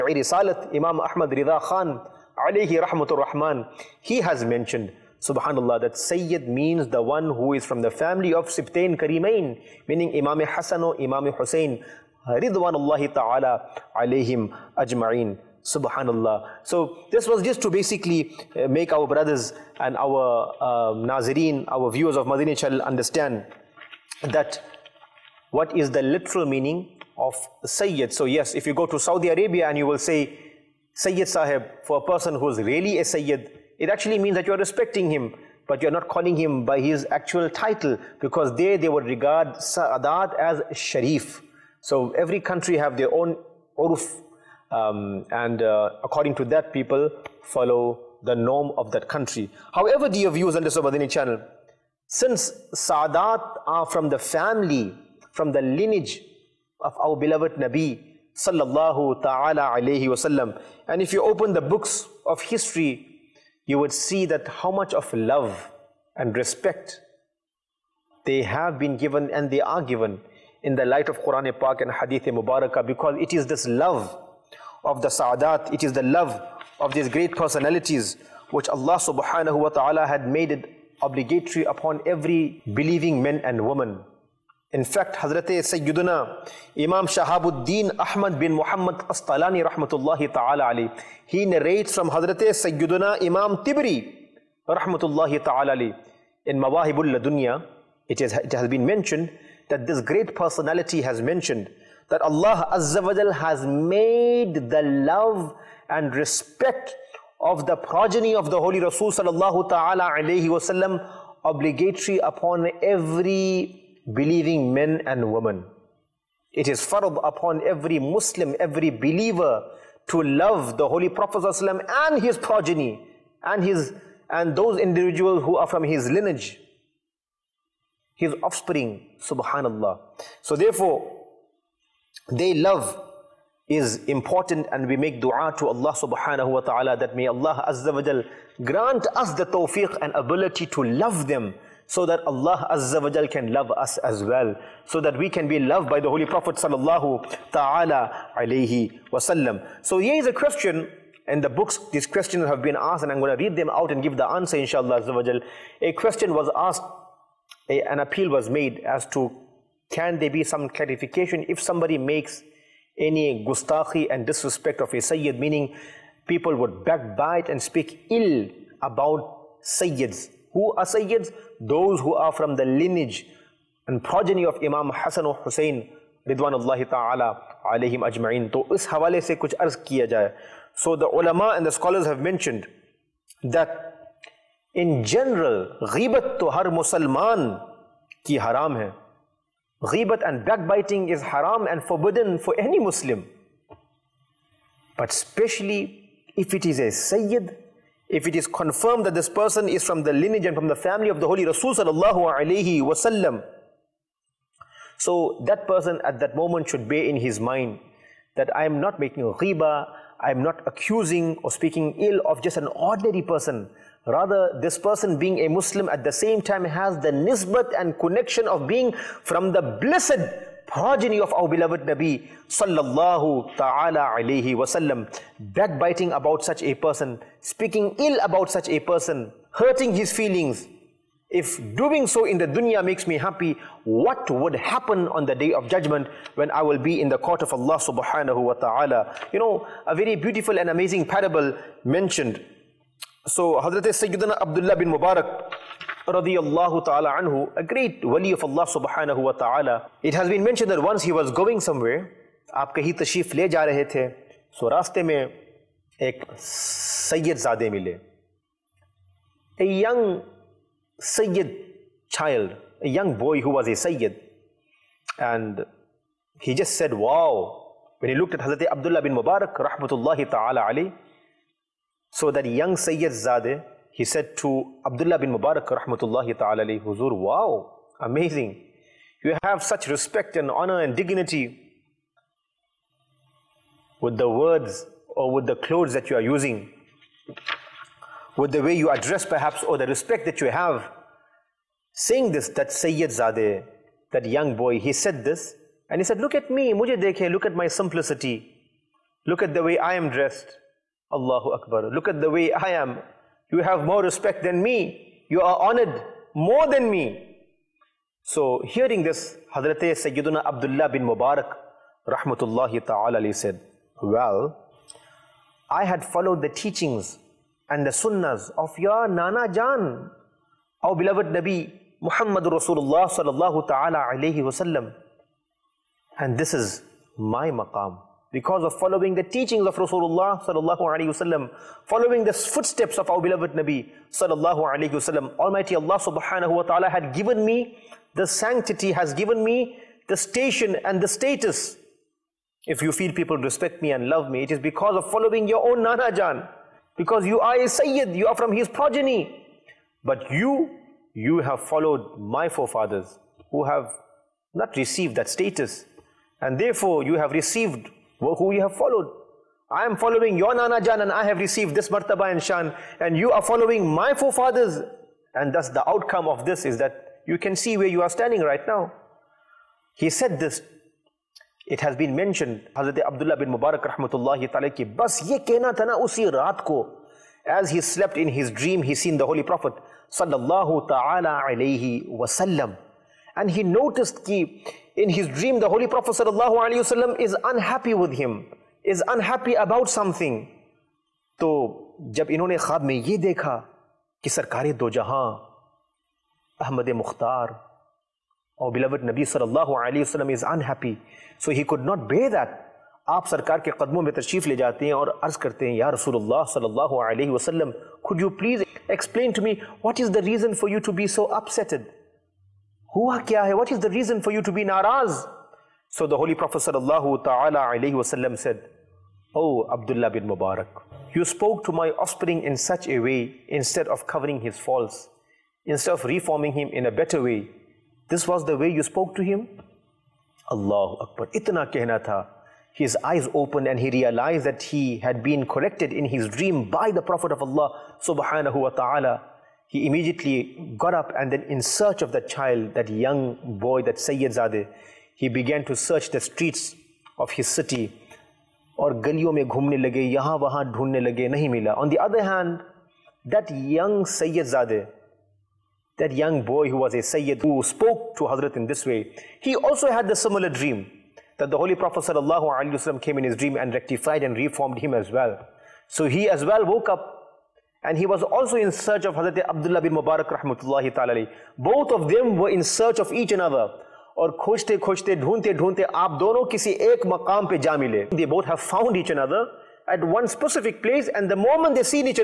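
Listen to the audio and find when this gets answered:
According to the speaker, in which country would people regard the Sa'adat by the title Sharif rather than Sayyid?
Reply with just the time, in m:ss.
0:28.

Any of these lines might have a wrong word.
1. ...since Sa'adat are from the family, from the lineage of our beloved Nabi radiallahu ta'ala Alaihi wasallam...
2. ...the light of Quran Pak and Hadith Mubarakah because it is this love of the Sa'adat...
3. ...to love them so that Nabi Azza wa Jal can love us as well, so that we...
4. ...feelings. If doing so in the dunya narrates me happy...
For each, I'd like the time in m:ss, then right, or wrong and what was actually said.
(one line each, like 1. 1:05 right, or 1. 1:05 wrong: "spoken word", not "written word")
1. 0:52 wrong: "sallallahu", not "radiallahu"
2. 1:10 right
3. 2:20 wrong: "Allah", not "Nabi"
4. 3:50 wrong: "makes", not "narrates".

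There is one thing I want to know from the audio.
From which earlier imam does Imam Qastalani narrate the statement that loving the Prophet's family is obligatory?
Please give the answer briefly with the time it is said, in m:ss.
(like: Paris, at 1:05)
Imam Tibri, at 1:33.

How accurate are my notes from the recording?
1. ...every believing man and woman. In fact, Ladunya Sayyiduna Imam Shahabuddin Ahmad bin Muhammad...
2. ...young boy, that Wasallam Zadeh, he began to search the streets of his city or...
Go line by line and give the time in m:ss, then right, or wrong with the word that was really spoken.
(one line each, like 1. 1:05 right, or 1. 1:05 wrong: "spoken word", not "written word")
1. 1:22 wrong: "Hazrat", not "Ladunya"
2. 7:22 wrong: "Sayyid", not "Wasallam".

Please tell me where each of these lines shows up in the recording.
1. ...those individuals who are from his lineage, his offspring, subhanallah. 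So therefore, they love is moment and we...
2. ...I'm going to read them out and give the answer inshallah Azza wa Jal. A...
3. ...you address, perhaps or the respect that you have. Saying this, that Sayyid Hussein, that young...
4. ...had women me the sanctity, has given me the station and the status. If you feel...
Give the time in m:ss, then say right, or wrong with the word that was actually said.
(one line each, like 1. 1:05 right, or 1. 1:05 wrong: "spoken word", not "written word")
1. 2:04 wrong: "important", not "moment"
2. 2:33 right
3. 4:48 wrong: "Zadeh", not "Hussein"
4. 5:36 wrong: "given", not "women".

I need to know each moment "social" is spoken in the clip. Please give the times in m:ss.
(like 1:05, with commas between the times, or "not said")
not said.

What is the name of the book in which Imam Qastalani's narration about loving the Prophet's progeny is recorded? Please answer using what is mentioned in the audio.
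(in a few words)
Mawahibul Ladunya.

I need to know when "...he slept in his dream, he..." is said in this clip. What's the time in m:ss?
6:17.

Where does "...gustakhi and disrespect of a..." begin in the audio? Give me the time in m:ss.
2:43.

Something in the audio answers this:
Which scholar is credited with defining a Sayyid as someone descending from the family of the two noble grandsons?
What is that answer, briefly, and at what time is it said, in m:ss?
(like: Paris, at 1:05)
Imam Ahmad Rida Khan, at 0:00.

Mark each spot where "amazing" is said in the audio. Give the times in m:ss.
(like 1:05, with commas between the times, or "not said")
4:00, 4:37.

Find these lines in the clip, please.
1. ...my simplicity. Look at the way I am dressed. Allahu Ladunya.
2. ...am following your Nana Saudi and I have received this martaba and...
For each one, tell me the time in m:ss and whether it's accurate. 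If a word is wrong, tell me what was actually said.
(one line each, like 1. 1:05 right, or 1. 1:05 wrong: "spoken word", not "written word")
1. 4:57 wrong: "Akbar", not "Ladunya"
2. 5:59 wrong: "Jan", not "Saudi".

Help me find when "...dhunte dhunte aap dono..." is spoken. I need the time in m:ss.
7:55.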